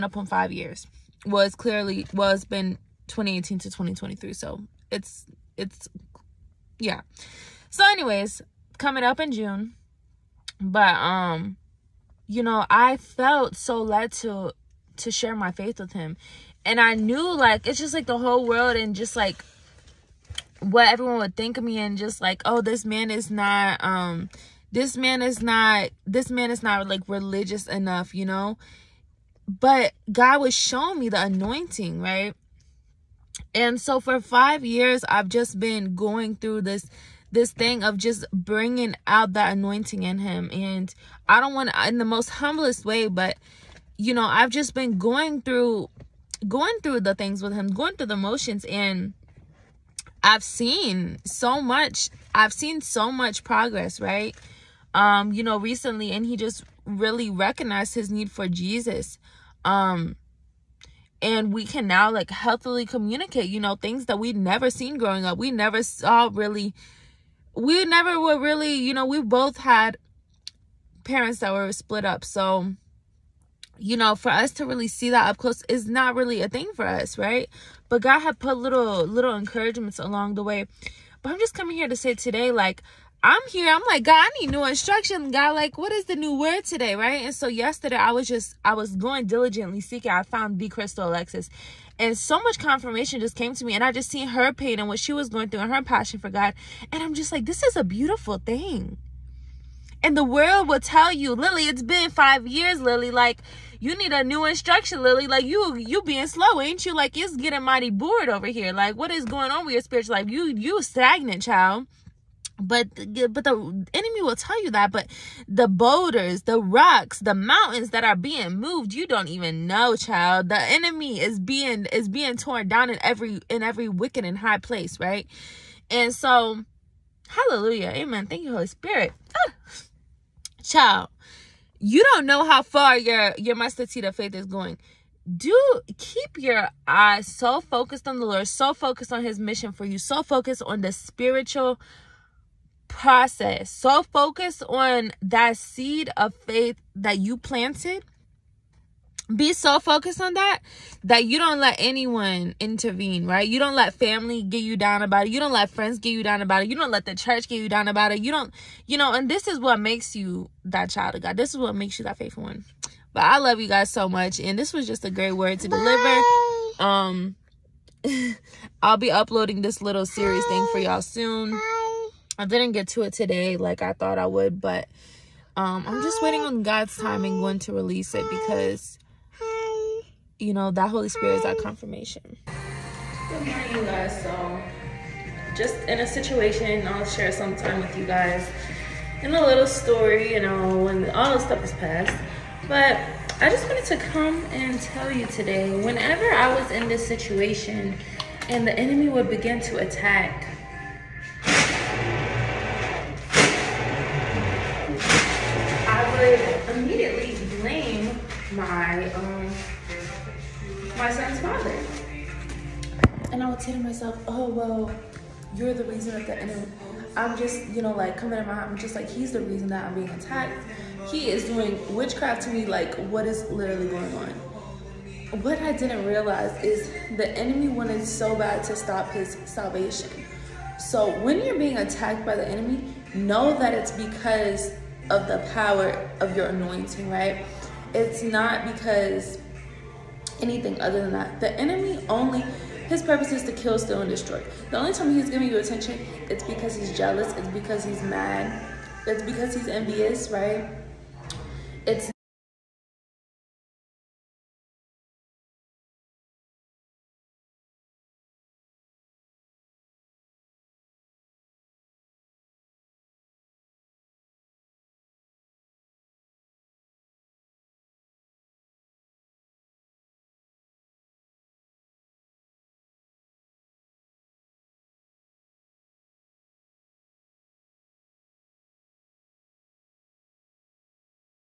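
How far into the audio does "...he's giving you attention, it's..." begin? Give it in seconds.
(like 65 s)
245 s.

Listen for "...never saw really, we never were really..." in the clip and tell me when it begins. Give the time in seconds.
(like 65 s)
65 s.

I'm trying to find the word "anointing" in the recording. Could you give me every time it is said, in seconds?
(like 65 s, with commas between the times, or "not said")
31 s, 39 s, 236 s.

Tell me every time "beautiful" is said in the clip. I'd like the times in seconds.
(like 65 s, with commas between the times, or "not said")
97 s.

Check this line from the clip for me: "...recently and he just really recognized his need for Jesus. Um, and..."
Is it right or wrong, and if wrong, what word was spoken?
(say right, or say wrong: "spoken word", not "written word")
right.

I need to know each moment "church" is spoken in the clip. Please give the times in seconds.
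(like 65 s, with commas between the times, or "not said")
157 s.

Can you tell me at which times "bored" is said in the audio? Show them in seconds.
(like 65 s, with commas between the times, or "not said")
107 s.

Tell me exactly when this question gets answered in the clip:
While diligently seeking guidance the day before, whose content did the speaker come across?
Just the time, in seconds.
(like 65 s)
90 s.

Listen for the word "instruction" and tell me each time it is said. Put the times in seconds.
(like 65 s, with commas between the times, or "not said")
84 s, 104 s.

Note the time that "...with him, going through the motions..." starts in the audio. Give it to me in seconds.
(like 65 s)
47 s.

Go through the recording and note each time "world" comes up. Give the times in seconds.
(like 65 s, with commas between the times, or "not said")
18 s, 100 s.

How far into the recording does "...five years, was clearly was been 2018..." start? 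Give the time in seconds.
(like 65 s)
0 s.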